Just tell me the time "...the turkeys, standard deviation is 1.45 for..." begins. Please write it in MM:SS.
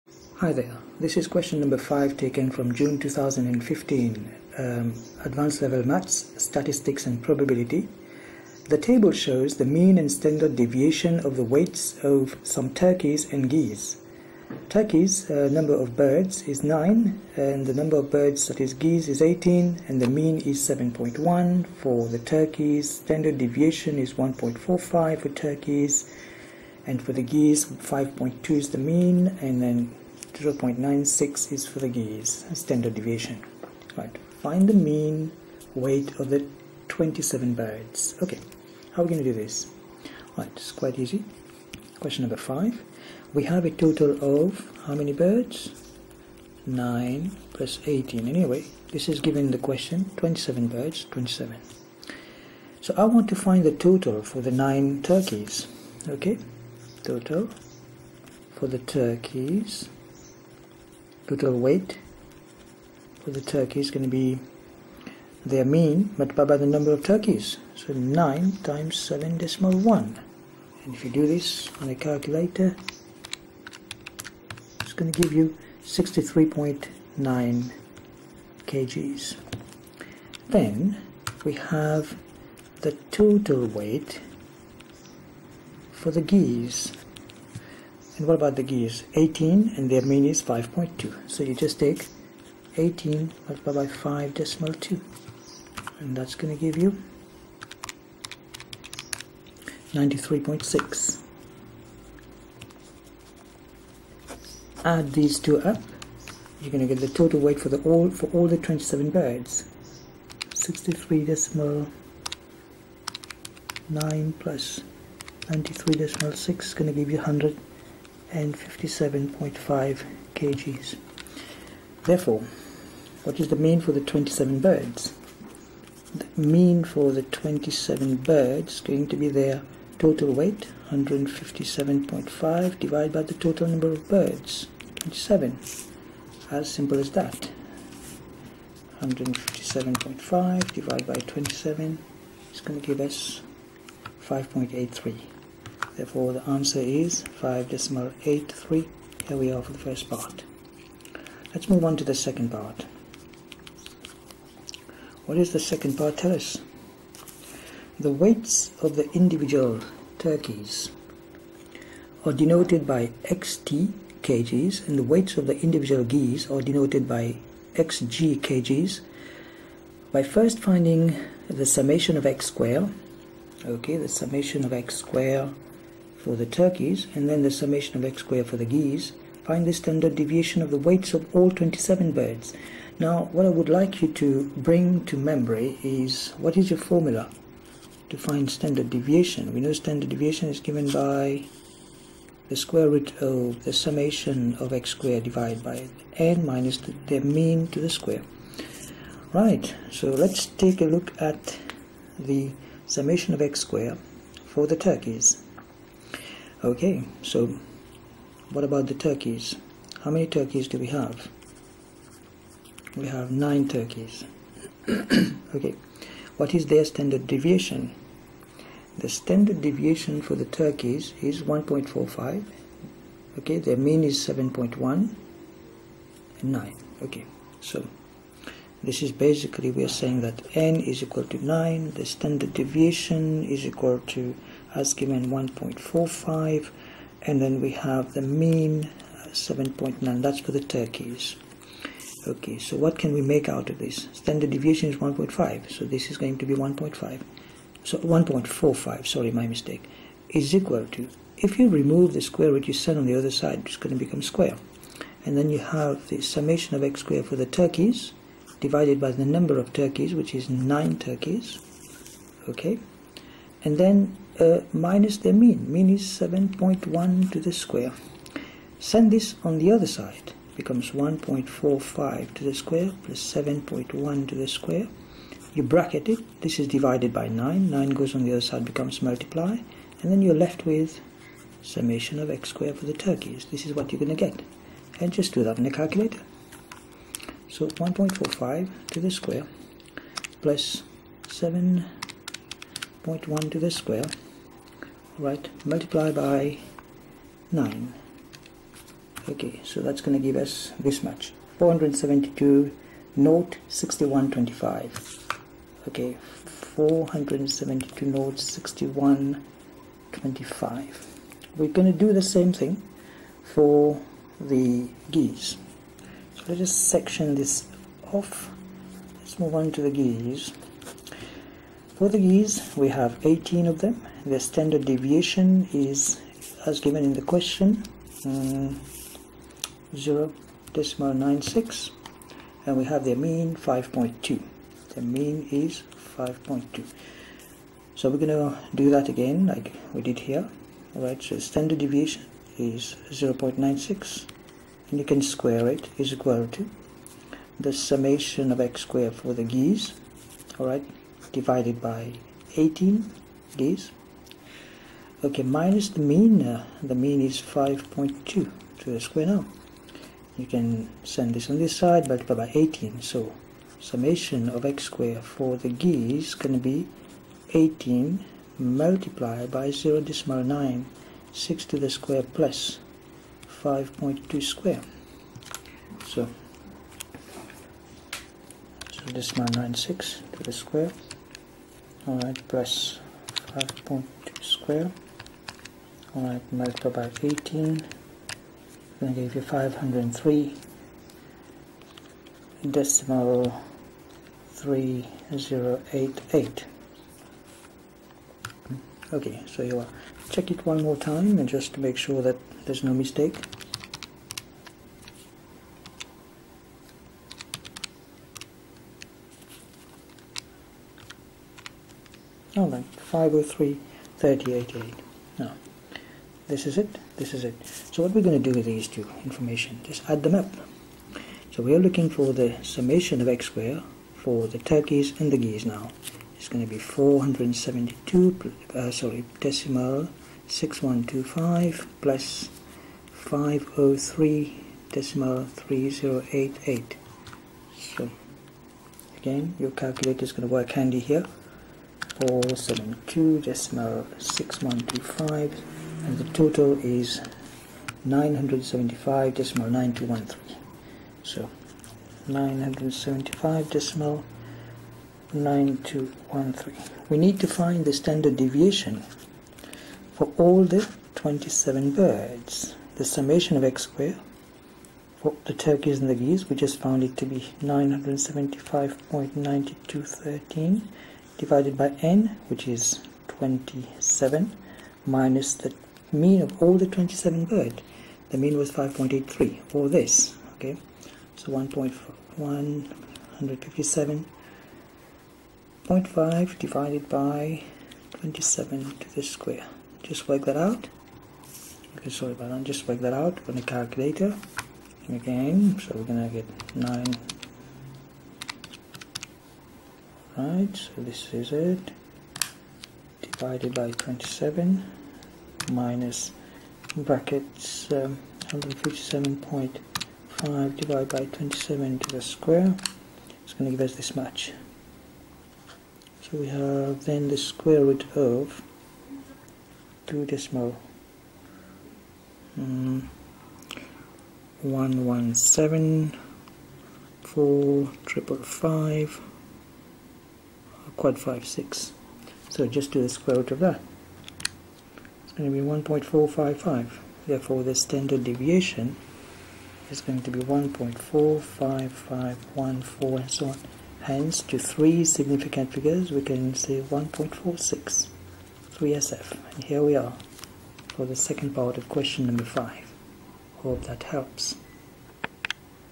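00:22.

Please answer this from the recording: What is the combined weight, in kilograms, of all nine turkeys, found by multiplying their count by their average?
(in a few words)
63.9.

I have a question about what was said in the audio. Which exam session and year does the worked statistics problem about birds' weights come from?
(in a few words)
June 2015.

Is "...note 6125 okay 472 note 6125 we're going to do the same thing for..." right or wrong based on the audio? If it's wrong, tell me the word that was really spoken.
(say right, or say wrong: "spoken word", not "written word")
right.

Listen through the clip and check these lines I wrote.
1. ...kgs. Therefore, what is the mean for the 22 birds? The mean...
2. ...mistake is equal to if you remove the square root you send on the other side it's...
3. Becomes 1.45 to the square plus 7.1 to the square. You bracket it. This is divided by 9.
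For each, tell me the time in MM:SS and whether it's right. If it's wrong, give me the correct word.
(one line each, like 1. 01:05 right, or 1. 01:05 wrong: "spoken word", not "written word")
1. 02:00 wrong: "27", not "22"
2. 04:09 right
3. 04:30 right.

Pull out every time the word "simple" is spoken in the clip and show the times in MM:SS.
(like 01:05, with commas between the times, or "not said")
02:16.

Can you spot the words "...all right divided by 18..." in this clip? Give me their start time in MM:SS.
05:50.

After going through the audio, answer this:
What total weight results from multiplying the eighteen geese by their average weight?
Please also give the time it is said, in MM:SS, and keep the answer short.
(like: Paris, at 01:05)
93.6, at 01:39.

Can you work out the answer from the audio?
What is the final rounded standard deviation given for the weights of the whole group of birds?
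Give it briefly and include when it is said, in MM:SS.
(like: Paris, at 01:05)
1.46, at 09:06.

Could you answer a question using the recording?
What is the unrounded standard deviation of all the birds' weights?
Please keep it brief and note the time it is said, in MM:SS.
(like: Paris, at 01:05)
1.45514, at 09:00.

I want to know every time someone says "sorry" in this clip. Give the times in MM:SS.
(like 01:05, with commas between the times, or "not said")
04:09, 07:08, 08:12.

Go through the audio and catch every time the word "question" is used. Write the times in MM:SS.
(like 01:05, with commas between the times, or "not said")
00:01, 00:41, 00:49, 05:27, 09:11.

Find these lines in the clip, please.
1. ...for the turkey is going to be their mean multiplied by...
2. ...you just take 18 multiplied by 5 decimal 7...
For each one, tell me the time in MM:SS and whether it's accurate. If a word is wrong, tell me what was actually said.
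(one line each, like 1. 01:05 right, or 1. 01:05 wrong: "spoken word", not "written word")
1. 01:03 right
2. 01:31 wrong: "2", not "7".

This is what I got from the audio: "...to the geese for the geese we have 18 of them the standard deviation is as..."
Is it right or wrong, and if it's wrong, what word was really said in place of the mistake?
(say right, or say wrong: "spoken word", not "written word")
right.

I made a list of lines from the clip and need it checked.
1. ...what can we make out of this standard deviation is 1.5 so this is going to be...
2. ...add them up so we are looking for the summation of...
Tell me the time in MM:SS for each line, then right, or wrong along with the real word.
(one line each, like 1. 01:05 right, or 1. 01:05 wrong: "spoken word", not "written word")
1. 04:02 right
2. 07:00 right.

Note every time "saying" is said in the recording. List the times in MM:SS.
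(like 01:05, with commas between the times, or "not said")
03:50.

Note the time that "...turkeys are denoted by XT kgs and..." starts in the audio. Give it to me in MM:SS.
02:40.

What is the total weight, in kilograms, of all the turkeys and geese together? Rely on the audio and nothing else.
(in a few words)
157.5.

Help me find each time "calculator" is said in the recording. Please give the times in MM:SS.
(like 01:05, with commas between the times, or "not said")
01:11, 04:45, 07:19, 08:13.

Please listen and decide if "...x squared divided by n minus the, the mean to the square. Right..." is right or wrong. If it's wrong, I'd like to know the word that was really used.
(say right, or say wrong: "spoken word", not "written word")
right.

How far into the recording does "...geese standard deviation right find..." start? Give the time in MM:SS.
00:31.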